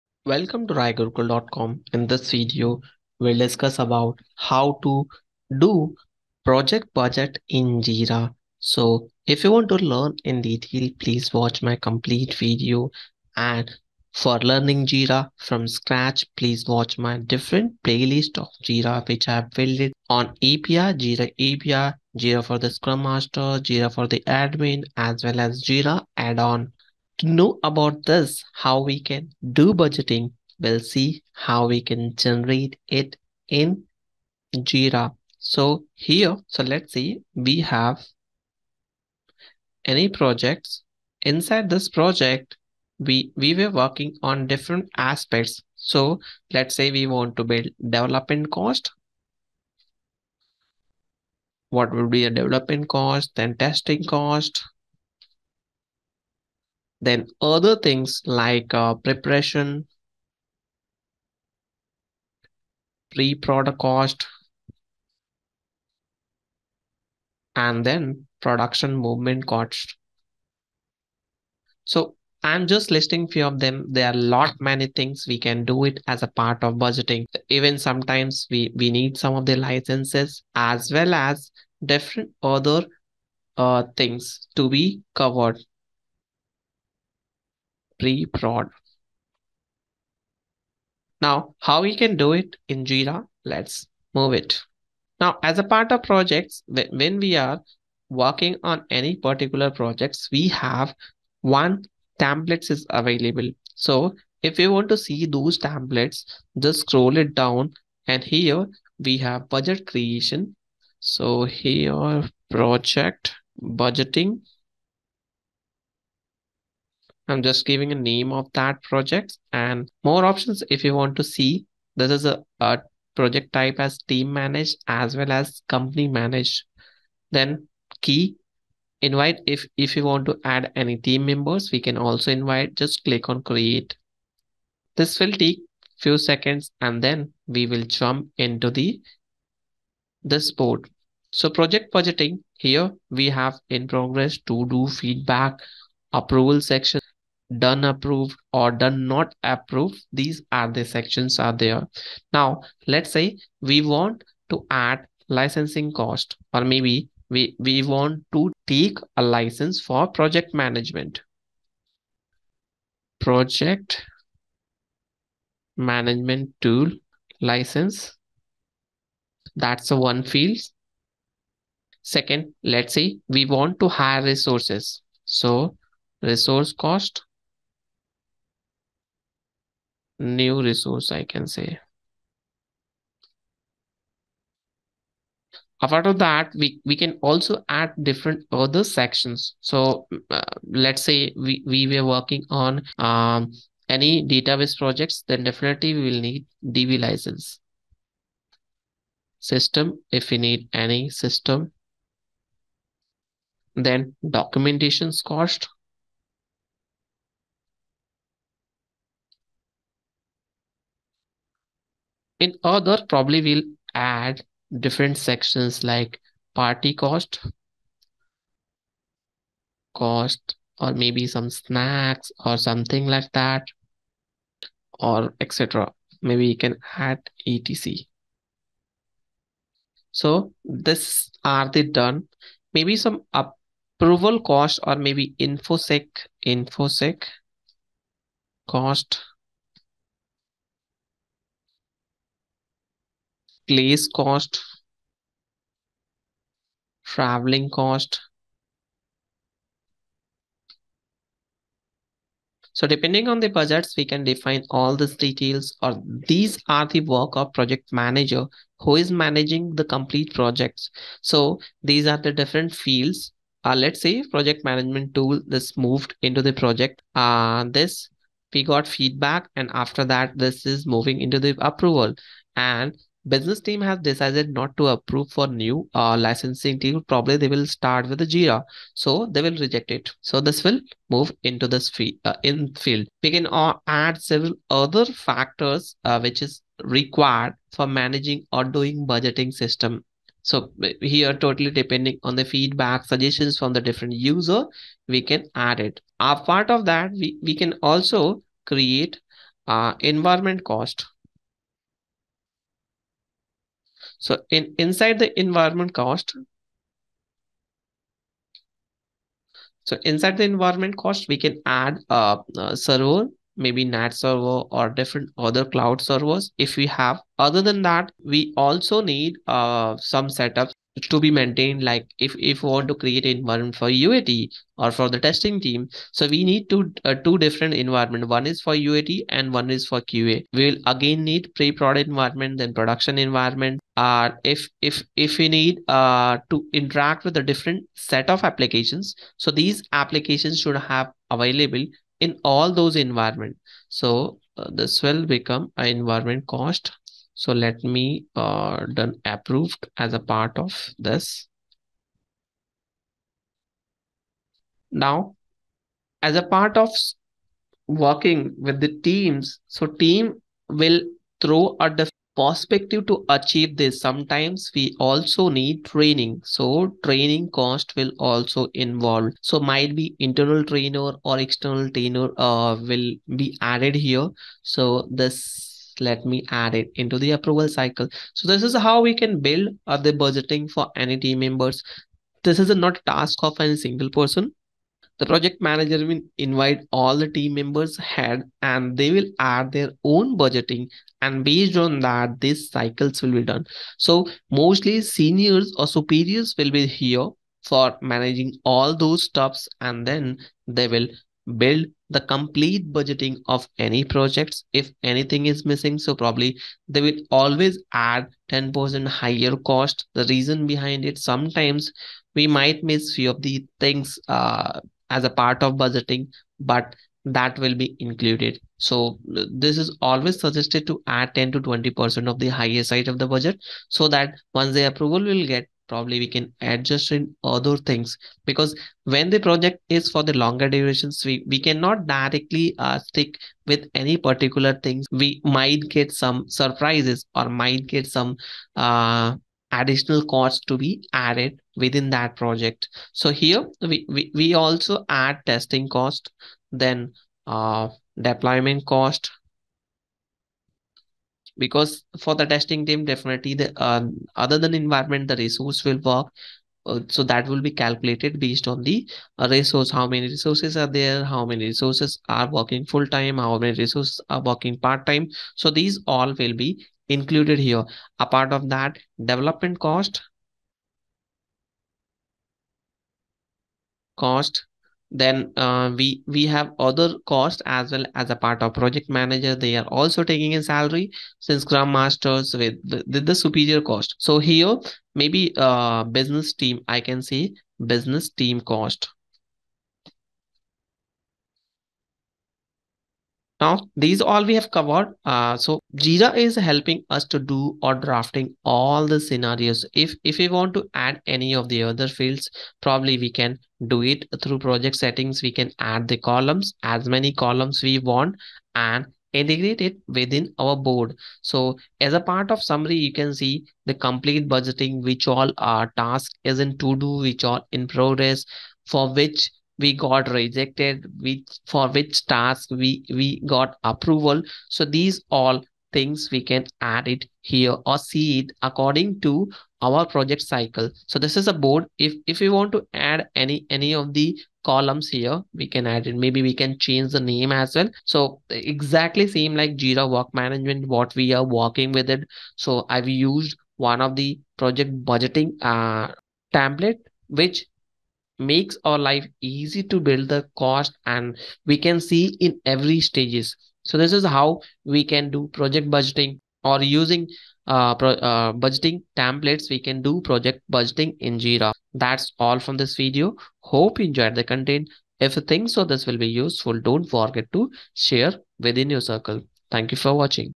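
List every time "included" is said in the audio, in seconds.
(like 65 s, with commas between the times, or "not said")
418 s, 467 s.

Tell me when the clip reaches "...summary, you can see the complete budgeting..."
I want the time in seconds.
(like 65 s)
512 s.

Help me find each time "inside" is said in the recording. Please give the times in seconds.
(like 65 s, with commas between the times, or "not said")
41 s, 304 s, 310 s.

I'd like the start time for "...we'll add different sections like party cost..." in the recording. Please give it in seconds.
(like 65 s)
213 s.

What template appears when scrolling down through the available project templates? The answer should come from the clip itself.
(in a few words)
budget creation.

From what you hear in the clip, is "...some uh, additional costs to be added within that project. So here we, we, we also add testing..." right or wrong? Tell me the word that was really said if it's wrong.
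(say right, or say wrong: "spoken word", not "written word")
right.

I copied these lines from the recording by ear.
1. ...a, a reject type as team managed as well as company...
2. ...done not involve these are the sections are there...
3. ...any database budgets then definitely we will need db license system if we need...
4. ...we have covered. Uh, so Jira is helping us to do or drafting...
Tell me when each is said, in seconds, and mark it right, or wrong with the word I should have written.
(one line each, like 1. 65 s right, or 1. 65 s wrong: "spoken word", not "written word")
1. 122 s wrong: "project", not "reject"
2. 148 s wrong: "approve", not "involve"
3. 193 s wrong: "projects", not "budgets"
4. 494 s right.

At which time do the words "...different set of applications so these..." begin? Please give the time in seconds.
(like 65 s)
337 s.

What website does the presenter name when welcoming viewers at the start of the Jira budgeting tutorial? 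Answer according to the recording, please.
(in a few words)
raigurukul.com.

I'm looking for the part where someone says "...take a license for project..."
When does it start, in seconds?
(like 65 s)
158 s.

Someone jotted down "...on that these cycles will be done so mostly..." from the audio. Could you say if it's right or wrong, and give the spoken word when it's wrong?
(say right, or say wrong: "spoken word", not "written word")
right.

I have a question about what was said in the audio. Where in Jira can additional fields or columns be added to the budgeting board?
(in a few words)
project settings.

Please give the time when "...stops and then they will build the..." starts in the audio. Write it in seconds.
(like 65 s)
399 s.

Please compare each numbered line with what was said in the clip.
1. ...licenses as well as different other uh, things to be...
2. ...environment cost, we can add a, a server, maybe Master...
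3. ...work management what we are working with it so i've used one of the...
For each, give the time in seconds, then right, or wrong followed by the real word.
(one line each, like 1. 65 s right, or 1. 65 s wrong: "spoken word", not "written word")
1. 79 s right
2. 310 s wrong: "NAT", not "Master"
3. 540 s right.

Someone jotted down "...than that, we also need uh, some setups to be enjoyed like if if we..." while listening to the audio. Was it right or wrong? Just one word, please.
wrong.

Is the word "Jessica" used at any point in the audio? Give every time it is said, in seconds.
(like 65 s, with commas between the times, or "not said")
not said.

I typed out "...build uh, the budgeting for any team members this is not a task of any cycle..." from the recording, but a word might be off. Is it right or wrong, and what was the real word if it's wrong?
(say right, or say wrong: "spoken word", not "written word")
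wrong: "single", not "cycle".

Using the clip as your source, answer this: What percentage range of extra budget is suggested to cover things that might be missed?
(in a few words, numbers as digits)
10 to 20 percent.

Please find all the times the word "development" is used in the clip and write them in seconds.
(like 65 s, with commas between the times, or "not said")
47 s, 52 s, 469 s.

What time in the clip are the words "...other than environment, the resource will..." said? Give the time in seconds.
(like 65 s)
454 s.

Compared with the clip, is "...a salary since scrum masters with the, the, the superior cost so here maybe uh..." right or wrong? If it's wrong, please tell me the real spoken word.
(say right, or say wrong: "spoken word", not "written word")
right.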